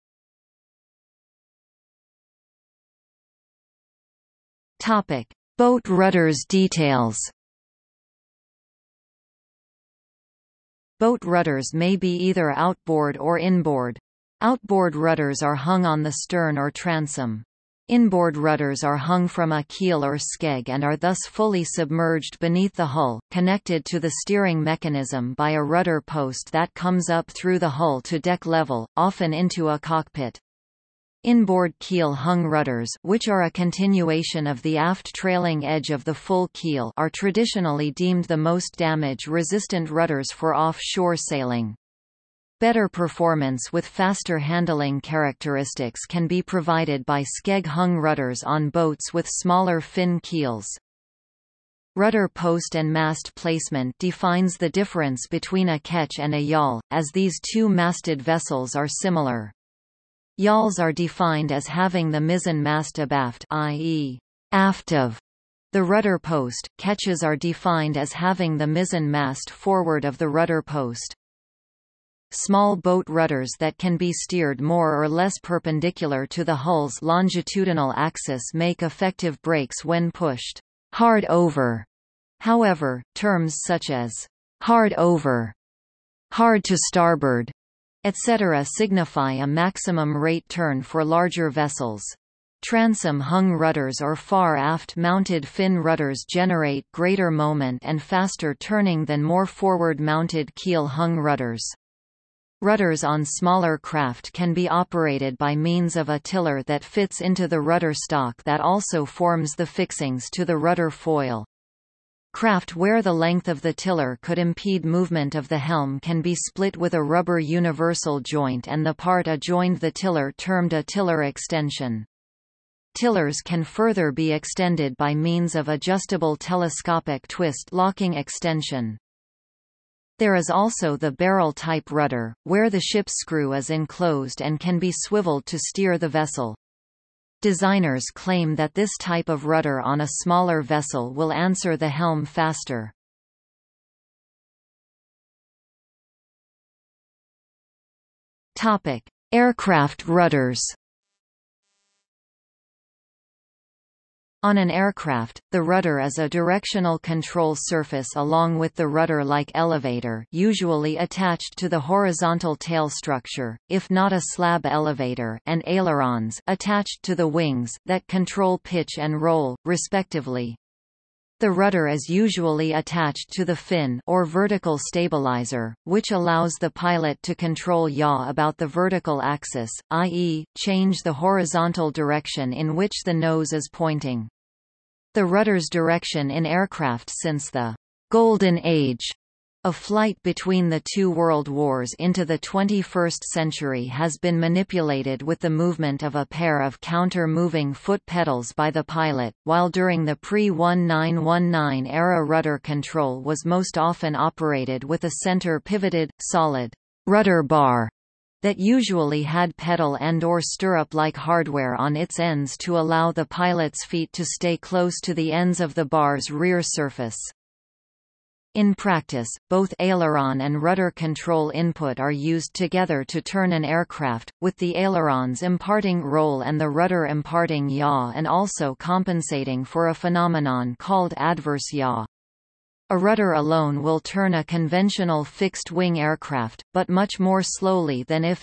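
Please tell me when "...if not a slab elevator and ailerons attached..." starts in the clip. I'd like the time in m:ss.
2:43.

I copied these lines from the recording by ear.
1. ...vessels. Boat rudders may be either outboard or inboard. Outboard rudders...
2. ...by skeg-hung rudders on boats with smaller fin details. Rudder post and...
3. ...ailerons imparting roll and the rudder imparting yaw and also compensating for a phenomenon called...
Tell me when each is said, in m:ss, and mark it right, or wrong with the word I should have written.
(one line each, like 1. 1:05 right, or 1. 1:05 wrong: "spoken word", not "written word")
1. 0:06 wrong: "details", not "vessels"
2. 0:47 wrong: "keels", not "details"
3. 3:44 right.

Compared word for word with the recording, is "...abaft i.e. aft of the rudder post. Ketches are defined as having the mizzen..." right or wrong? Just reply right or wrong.
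right.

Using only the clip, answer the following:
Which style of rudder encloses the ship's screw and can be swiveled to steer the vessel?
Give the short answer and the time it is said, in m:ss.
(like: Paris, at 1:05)
barrel-type rudder, at 2:11.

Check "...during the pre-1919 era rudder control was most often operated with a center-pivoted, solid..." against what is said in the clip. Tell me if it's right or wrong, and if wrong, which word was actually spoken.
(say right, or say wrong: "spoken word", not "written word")
right.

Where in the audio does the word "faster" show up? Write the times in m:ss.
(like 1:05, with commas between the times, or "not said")
0:43, 1:38, 2:22.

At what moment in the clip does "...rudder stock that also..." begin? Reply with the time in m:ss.
1:47.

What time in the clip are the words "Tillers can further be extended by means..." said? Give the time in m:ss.
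2:02.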